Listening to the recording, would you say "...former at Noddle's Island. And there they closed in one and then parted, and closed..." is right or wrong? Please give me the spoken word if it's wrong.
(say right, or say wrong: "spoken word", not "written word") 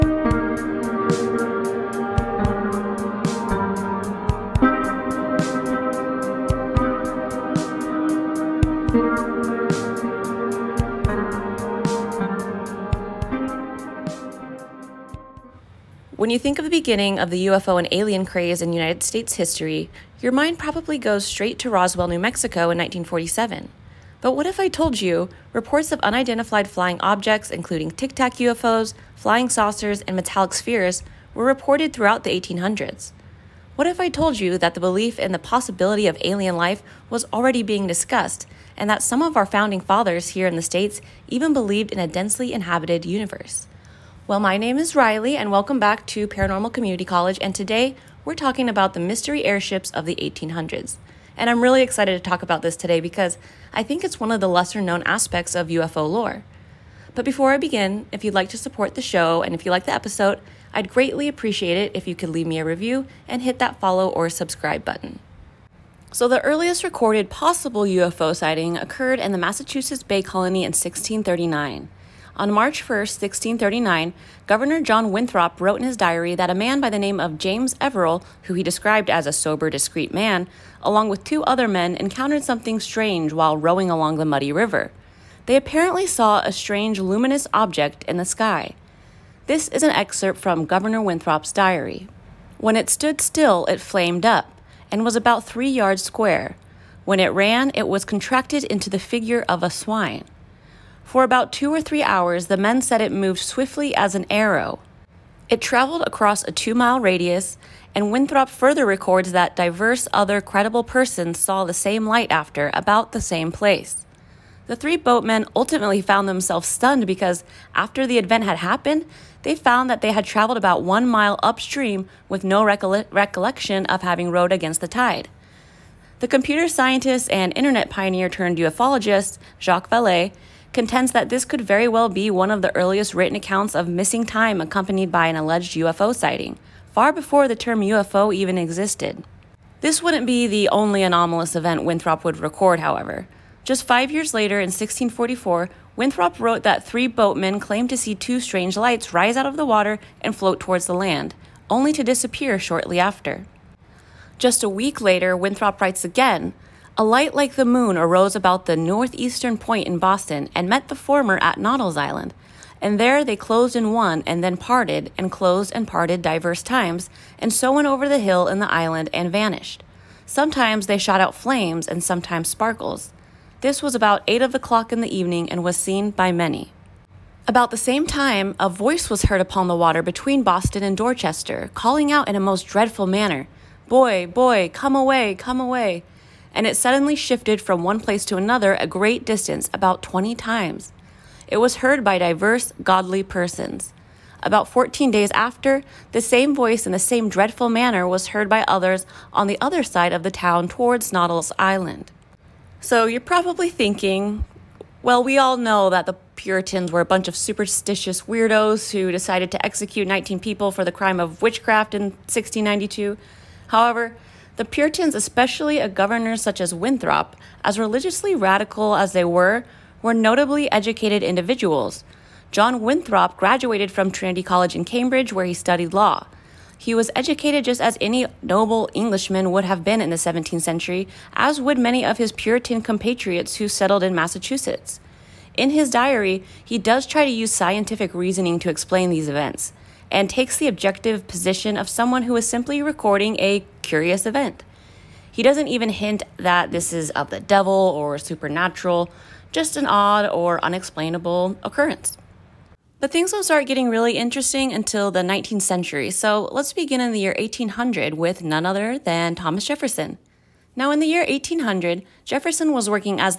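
right.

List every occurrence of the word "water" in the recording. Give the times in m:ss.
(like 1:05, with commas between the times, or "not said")
2:29, 2:59.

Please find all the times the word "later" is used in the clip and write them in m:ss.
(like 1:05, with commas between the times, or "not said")
2:24, 2:34.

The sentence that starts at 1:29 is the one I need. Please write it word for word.
This is an excerpt from Governor Winthrop's diary.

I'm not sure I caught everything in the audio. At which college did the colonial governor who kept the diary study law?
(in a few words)
Trinity College.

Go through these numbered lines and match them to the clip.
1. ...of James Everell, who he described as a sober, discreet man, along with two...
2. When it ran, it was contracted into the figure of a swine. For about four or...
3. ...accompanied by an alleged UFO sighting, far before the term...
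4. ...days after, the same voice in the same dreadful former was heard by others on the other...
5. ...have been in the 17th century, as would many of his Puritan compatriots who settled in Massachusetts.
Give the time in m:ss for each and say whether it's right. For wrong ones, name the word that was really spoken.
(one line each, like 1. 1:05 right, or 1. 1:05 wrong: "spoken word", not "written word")
1. 1:17 right
2. 1:37 wrong: "two", not "four"
3. 2:14 right
4. 3:15 wrong: "manner", not "former"
5. 3:49 right.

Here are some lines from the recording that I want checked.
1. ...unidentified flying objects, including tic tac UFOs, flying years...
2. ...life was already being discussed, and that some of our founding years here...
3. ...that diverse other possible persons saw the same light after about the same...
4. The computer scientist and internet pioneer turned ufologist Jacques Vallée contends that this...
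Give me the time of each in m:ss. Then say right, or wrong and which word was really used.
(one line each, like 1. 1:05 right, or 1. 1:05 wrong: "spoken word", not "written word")
1. 0:25 wrong: "saucers", not "years"
2. 0:36 wrong: "fathers", not "years"
3. 1:49 wrong: "credible", not "possible"
4. 2:06 right.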